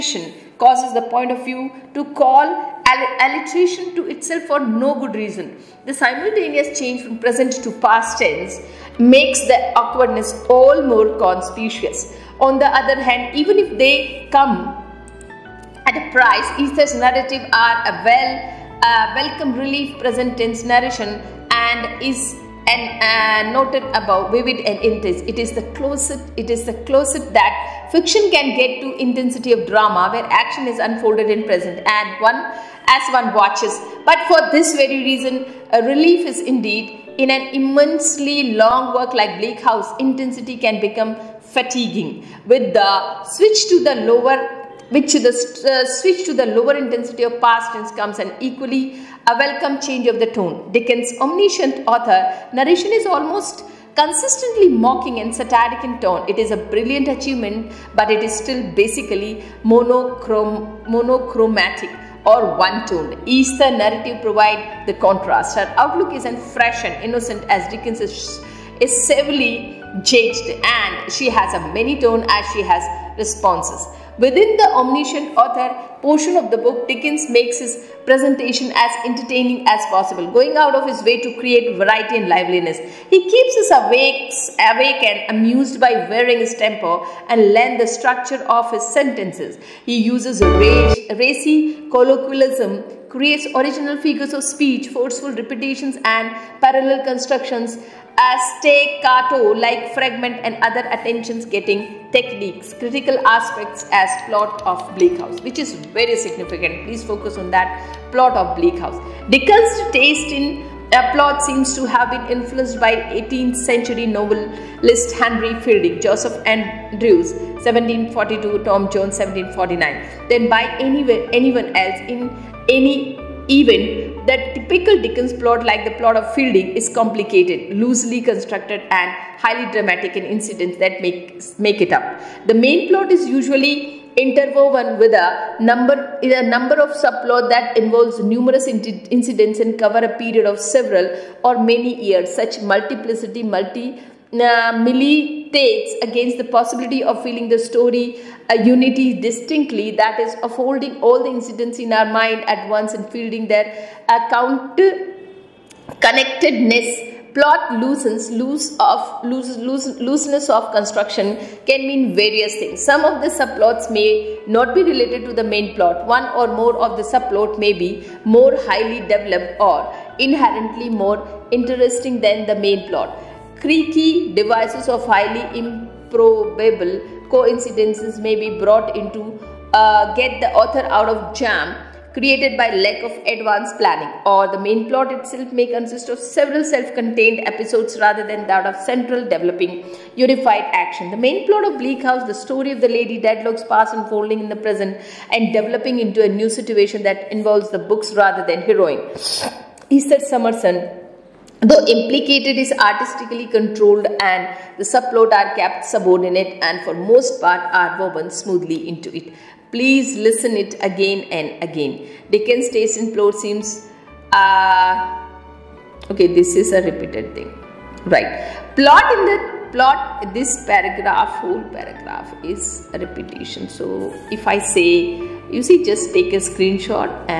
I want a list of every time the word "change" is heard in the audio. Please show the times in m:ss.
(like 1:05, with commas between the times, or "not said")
0:06, 0:49.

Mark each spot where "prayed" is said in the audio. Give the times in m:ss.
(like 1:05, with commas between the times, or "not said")
not said.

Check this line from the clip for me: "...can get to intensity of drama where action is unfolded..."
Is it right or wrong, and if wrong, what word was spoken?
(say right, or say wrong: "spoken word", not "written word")
right.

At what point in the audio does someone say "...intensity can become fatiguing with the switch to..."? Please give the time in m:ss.
0:39.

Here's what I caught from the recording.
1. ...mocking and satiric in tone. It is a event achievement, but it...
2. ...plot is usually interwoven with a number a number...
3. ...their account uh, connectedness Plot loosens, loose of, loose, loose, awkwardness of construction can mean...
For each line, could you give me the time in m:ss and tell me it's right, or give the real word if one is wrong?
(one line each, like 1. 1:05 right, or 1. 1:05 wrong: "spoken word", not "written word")
1. 0:54 wrong: "brilliant", not "event"
2. 2:12 right
3. 2:33 wrong: "looseness", not "awkwardness".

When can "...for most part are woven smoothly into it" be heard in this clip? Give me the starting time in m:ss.
3:26.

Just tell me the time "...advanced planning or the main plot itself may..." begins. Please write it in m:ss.
3:03.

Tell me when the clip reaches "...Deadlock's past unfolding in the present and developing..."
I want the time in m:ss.
3:13.